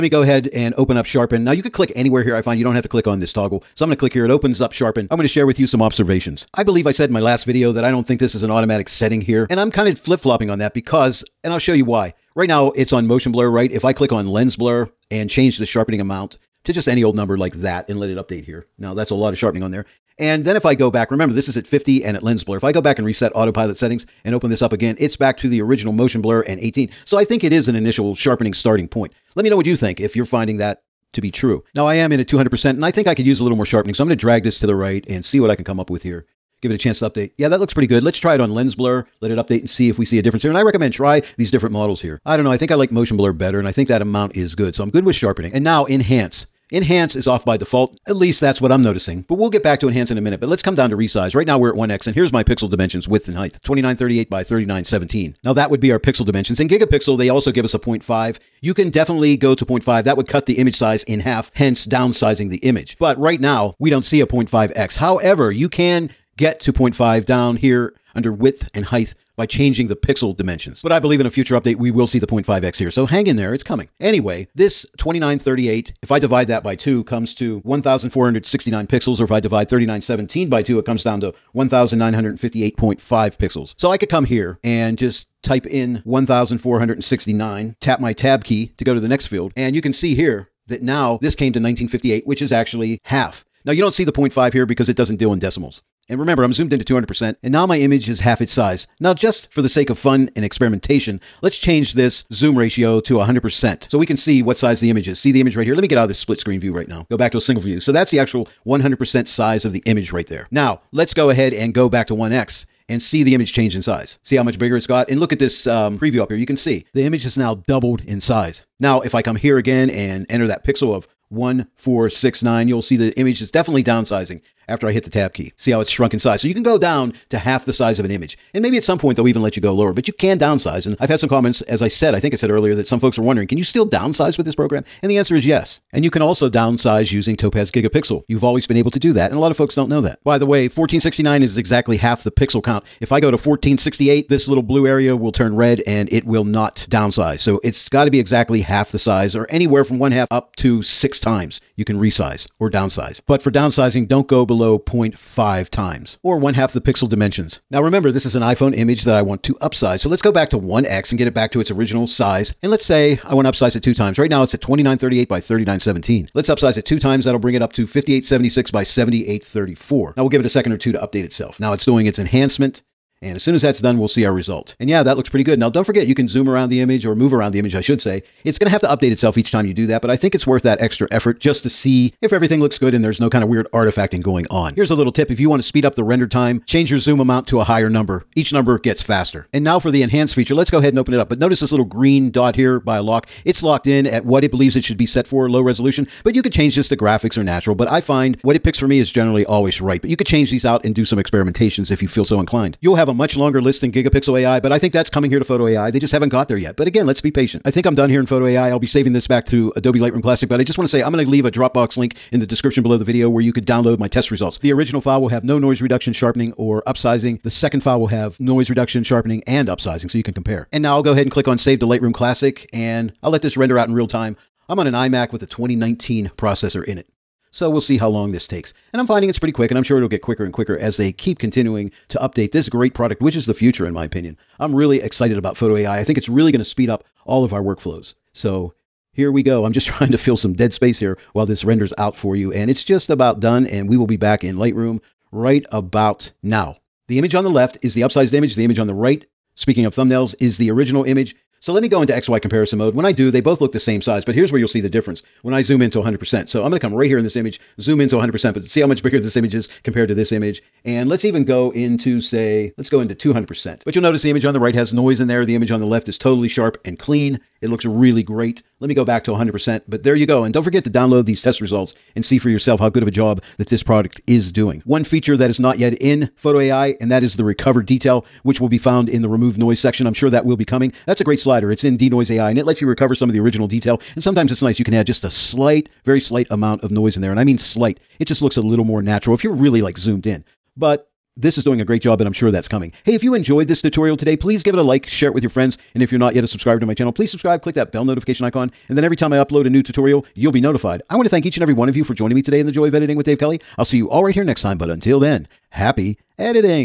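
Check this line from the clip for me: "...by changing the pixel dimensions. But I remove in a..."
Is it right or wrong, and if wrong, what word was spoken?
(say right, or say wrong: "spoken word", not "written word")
wrong: "believe", not "remove".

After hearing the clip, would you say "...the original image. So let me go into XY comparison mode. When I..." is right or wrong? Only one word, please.
right.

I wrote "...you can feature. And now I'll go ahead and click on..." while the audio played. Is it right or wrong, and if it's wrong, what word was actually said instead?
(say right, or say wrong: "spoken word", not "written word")
wrong: "compare", not "feature".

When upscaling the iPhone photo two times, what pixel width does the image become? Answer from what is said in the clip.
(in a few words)
5876.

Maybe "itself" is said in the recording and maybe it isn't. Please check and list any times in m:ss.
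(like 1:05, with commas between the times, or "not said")
2:51, 2:59.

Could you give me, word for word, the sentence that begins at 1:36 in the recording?
And remember, I'm zoomed into 200%, and now my image is half its size.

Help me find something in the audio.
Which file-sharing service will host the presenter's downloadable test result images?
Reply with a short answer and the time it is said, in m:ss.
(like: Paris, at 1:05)
Dropbox, at 3:31.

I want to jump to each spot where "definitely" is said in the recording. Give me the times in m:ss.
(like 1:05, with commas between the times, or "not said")
0:58, 2:03.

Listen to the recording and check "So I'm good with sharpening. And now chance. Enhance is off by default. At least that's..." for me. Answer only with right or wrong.
wrong.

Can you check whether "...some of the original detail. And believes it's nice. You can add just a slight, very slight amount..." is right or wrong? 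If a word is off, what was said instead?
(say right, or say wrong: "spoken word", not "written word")
wrong: "sometimes", not "believes".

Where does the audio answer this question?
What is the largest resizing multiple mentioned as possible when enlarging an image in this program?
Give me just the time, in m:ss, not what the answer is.
2:30.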